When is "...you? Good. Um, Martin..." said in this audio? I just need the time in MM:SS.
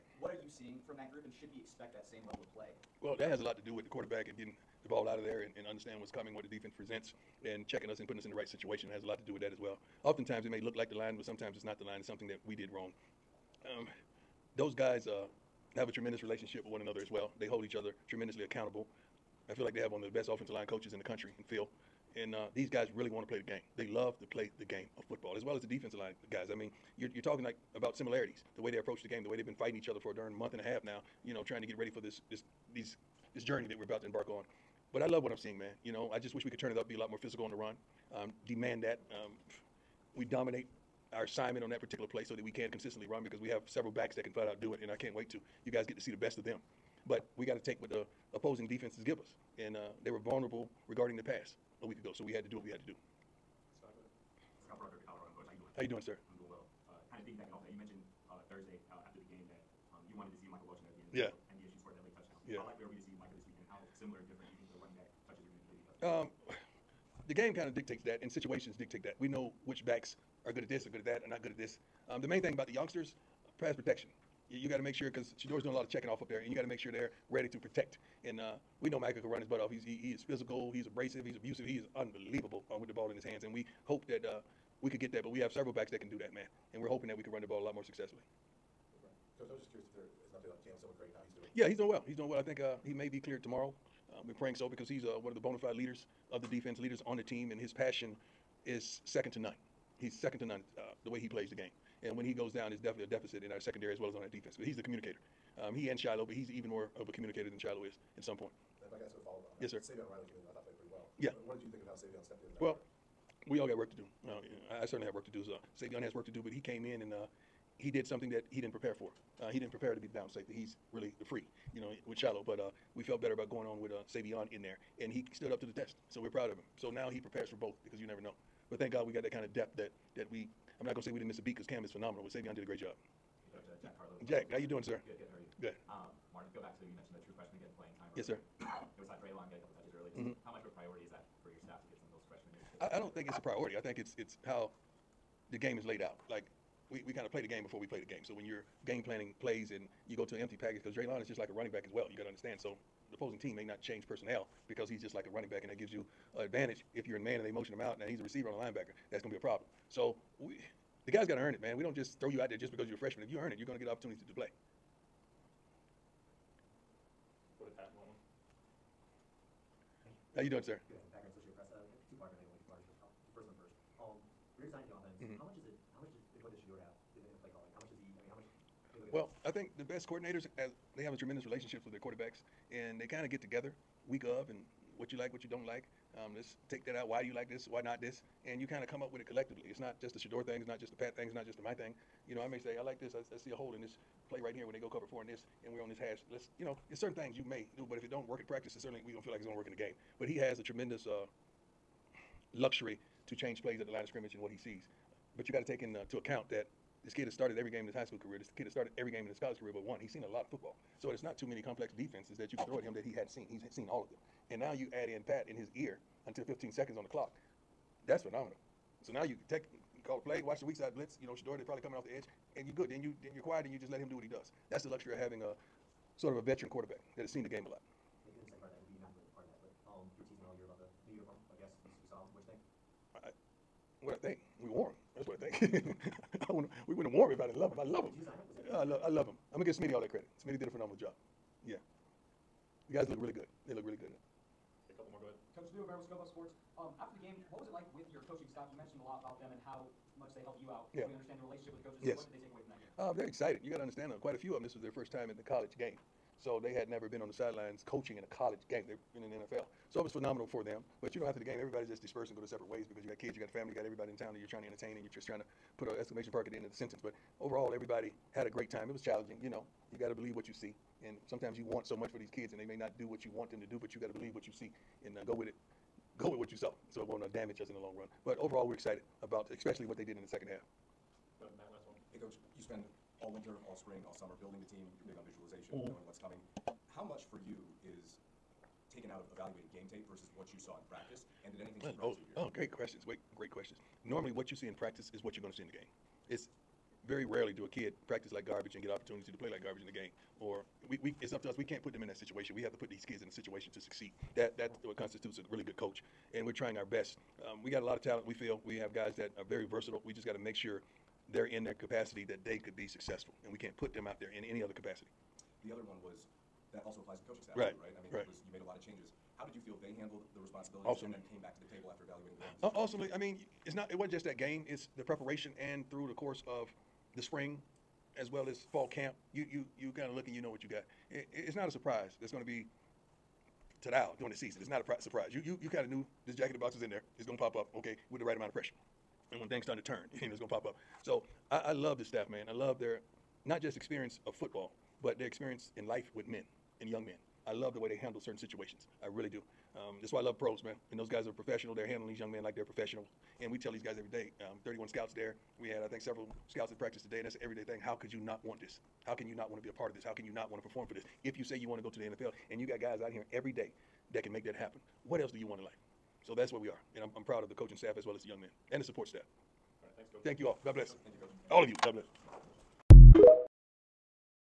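02:15.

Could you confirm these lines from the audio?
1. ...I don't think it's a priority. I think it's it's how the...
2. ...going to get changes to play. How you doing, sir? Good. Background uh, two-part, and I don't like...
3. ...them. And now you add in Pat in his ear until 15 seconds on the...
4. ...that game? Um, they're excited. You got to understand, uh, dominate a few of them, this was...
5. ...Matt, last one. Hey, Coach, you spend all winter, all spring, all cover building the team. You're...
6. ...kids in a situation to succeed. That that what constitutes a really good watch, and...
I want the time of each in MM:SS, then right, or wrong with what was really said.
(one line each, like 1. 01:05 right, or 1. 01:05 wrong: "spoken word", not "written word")
1. 02:22 right
2. 02:43 wrong: "opportunities", not "changes"
3. 03:34 right
4. 04:12 wrong: "quite", not "dominate"
5. 04:41 wrong: "summer", not "cover"
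6. 05:03 wrong: "coach", not "watch".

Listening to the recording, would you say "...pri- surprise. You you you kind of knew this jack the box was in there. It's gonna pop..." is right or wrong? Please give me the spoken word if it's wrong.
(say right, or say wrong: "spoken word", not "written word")
right.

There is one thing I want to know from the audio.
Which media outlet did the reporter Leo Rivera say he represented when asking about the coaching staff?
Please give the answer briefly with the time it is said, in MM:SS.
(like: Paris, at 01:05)
Scoville Sports, at 04:06.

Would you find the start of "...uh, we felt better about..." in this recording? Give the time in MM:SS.
02:02.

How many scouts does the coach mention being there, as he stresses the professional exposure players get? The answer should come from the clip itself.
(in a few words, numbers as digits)
31.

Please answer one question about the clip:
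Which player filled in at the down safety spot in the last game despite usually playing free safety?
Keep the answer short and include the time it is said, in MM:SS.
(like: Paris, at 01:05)
Savion Riley, at 01:49.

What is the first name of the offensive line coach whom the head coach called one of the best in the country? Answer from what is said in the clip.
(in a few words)
Phil.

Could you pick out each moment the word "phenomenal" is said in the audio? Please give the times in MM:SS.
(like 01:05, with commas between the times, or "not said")
02:11, 03:38, 04:00, 04:20.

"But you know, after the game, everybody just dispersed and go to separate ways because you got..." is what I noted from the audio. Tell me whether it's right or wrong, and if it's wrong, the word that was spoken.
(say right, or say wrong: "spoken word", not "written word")
right.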